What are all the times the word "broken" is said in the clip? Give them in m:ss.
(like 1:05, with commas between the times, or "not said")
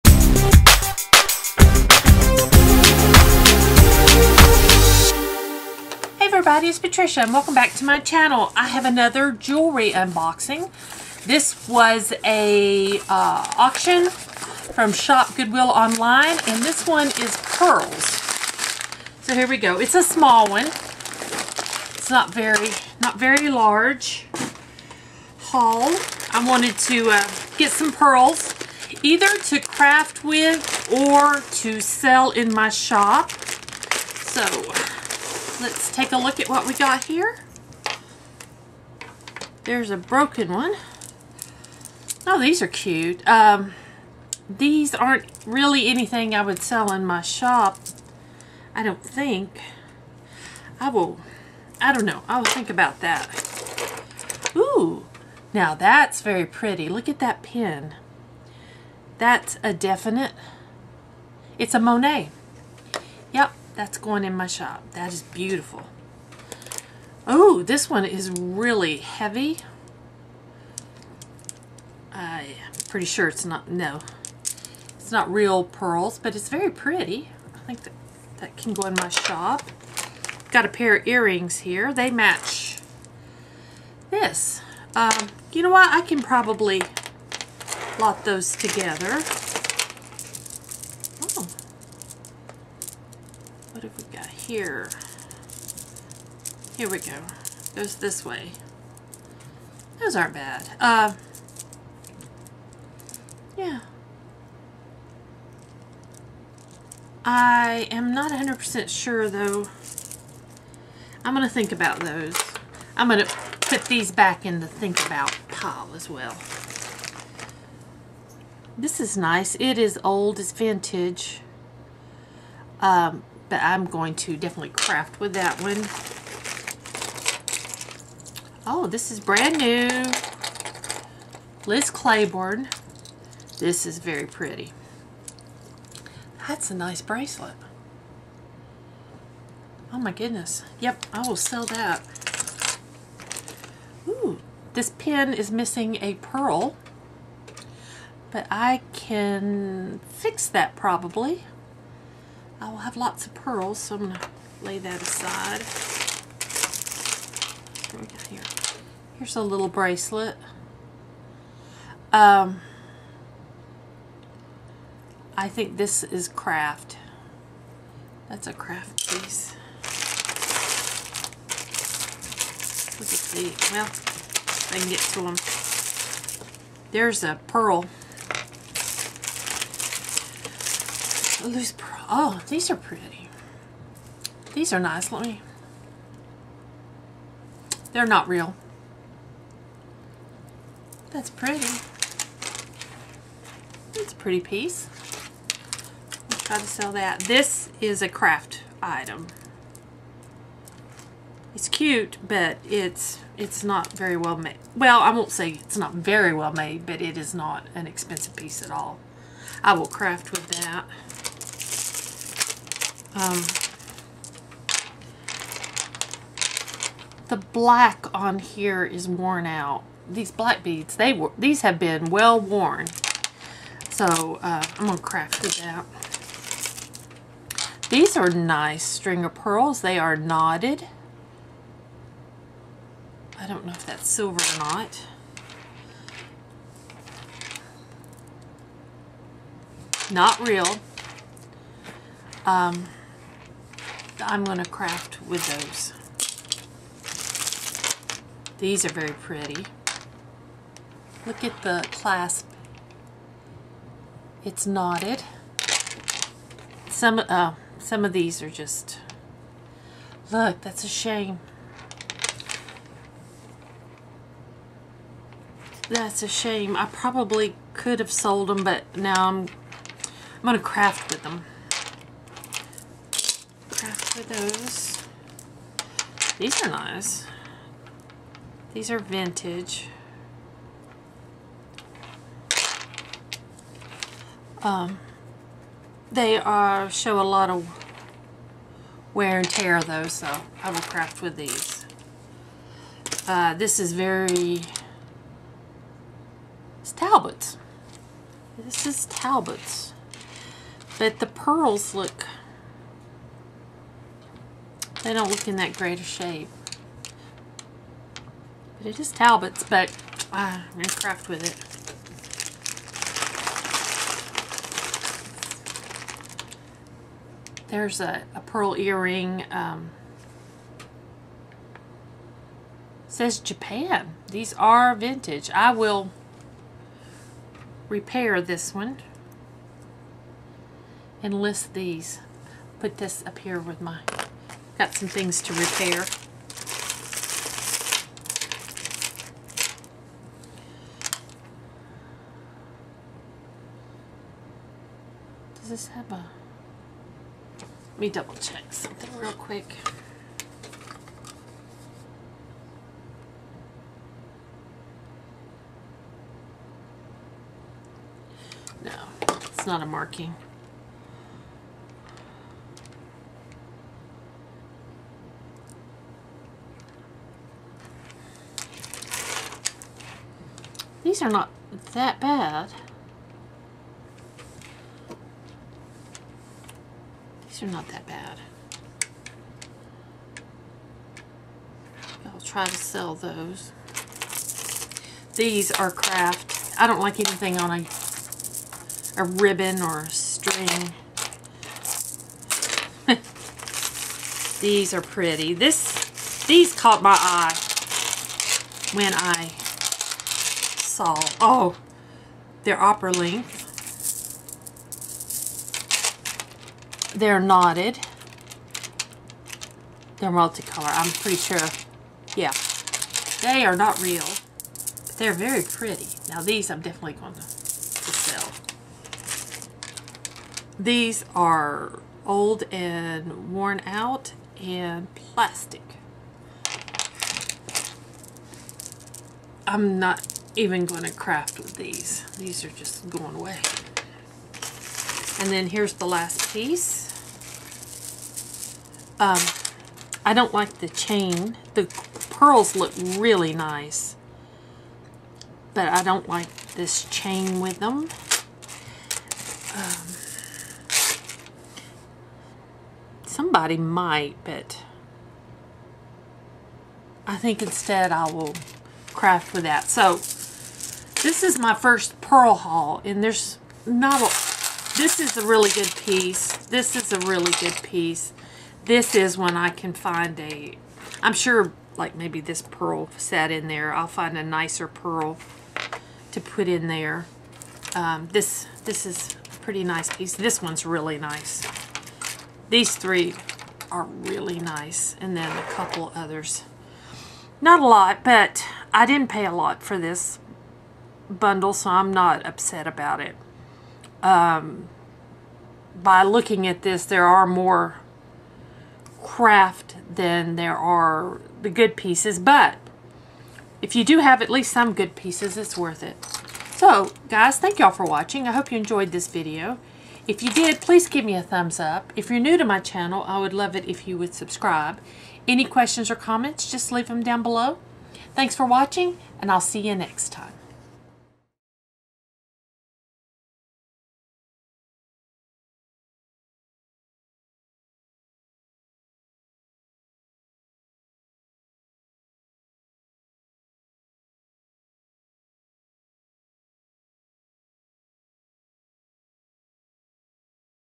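0:39.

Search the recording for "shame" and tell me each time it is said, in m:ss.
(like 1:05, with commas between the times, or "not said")
4:20, 4:26.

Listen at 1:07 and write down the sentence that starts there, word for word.
Oh, this one is really heavy.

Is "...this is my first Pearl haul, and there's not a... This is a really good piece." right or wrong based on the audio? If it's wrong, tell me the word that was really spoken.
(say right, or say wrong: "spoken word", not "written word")
right.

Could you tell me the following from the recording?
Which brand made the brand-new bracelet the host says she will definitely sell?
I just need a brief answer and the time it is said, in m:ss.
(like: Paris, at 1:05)
Liz Claiborne, at 2:11.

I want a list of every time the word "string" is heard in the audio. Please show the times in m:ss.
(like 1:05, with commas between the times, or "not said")
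3:48, 6:30.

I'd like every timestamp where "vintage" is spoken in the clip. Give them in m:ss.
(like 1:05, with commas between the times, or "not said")
2:00, 4:38, 5:24.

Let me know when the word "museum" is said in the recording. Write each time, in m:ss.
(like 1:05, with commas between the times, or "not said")
not said.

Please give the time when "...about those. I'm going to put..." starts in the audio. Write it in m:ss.
1:51.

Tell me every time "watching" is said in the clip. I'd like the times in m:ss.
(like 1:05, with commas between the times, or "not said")
8:28, 8:38.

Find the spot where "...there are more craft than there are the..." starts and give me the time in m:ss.
8:17.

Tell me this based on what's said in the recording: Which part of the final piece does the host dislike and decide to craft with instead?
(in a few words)
The chain.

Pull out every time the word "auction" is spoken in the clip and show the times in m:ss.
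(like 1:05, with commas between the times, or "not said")
0:13.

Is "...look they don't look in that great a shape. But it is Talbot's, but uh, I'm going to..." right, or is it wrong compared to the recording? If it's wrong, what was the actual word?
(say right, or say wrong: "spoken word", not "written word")
right.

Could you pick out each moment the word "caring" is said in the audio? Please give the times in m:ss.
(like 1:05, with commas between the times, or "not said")
not said.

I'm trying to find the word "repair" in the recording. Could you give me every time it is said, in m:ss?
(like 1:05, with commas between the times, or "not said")
5:27, 5:35.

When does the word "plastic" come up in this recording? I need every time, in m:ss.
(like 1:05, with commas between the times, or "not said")
7:05.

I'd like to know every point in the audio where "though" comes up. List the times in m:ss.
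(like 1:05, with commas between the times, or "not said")
1:49, 4:49.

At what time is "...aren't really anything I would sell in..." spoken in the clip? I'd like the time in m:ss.
0:44.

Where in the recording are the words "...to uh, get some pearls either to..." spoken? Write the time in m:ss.
0:26.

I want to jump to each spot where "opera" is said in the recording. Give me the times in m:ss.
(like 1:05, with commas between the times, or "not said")
6:42.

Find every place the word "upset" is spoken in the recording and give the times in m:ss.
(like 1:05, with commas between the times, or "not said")
8:12.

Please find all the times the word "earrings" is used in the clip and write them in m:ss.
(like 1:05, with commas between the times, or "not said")
1:21, 5:18.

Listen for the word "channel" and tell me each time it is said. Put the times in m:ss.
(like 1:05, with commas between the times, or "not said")
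0:07, 8:32.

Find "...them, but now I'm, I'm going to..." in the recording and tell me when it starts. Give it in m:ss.
4:28.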